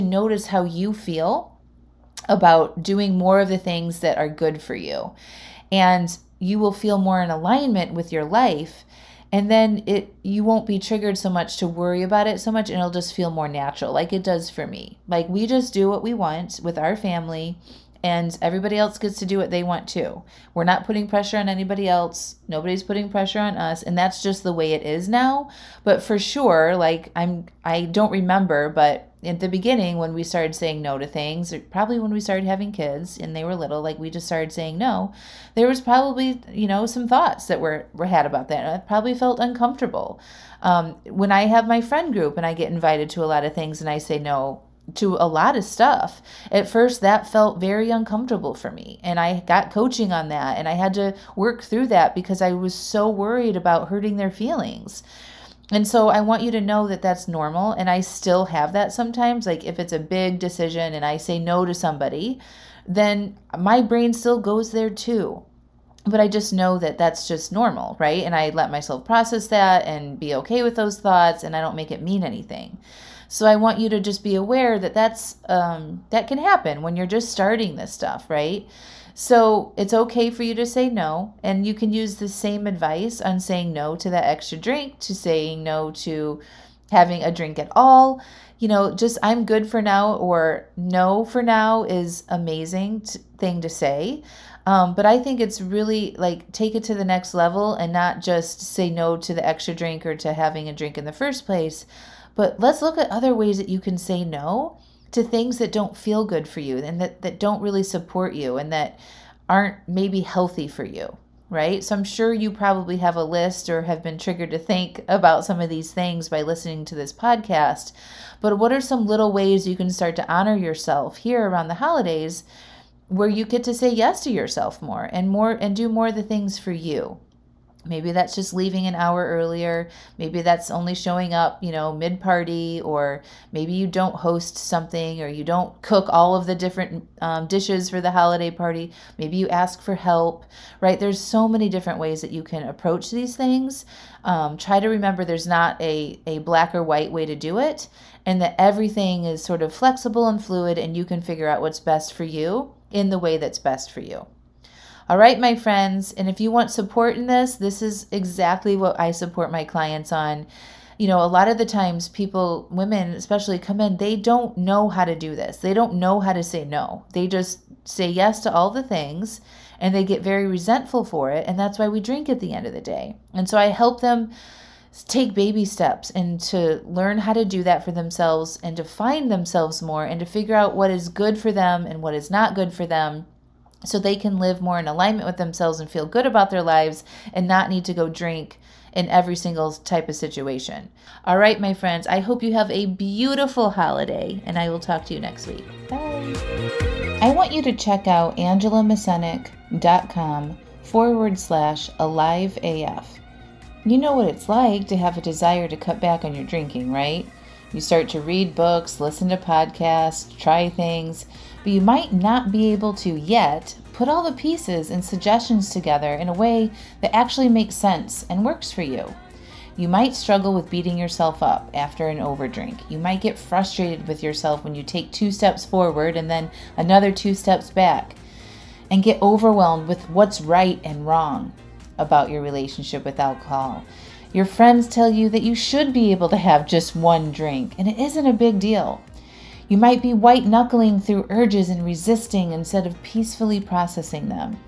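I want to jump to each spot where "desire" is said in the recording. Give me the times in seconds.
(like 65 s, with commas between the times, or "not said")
205 s.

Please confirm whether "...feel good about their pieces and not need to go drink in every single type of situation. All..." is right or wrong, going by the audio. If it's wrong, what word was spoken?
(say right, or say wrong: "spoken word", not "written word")
wrong: "lives", not "pieces".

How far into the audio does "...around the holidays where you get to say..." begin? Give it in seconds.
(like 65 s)
121 s.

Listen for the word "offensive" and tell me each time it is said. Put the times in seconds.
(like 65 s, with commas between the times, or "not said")
not said.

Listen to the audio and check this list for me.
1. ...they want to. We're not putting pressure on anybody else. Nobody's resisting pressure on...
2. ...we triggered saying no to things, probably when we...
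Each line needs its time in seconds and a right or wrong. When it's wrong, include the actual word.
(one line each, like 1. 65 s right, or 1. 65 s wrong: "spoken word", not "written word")
1. 19 s wrong: "putting", not "resisting"
2. 30 s wrong: "started", not "triggered".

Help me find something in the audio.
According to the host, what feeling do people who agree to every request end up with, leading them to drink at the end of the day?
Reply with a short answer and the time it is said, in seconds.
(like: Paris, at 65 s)
Resentful, at 170 s.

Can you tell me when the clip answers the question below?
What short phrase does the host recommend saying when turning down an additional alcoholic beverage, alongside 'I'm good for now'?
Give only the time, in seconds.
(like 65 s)
90 s.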